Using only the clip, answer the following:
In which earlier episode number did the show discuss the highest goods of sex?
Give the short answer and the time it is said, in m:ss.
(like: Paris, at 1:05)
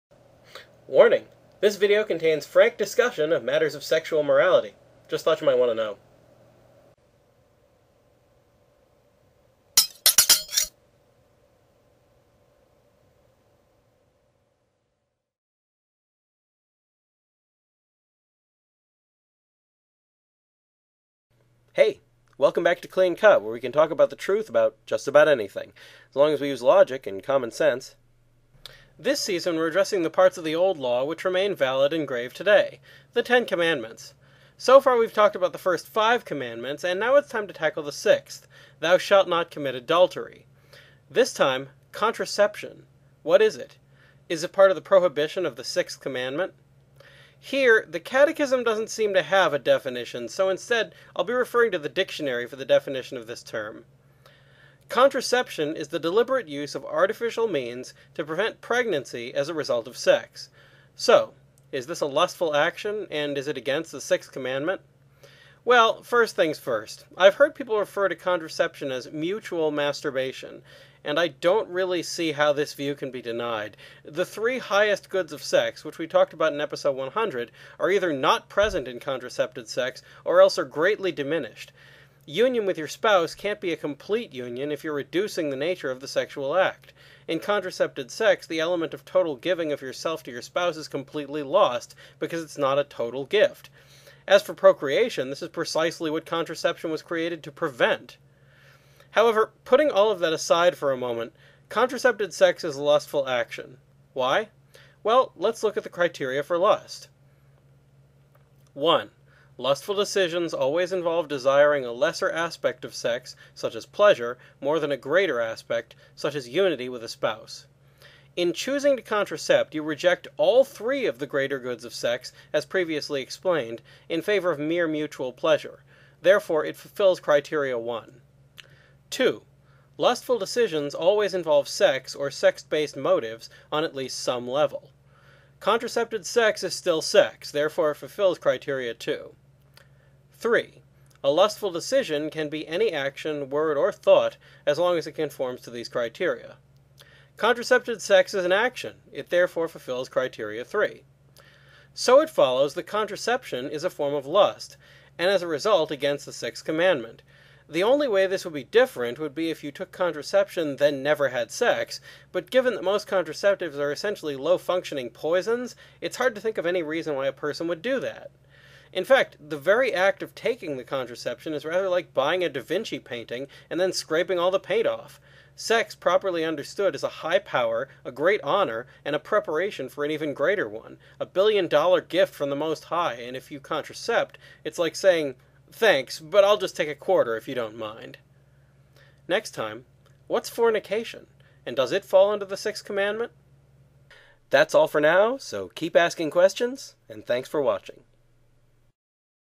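100, at 1:16.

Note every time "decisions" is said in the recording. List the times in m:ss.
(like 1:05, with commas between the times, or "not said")
1:49, 2:10, 2:21.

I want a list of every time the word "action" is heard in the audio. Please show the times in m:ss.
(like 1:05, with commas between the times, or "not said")
1:02, 1:43, 2:22, 2:28.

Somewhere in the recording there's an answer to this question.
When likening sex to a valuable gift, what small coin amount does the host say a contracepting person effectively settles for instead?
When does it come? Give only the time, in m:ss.
3:06.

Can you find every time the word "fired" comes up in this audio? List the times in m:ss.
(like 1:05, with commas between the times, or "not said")
not said.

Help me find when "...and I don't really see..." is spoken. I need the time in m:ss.
1:11.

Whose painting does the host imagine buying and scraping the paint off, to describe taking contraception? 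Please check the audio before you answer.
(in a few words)
Da Vinci.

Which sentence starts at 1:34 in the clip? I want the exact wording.
As for procreation, this is precisely what contraception was created to prevent.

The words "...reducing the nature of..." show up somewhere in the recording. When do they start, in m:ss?
1:24.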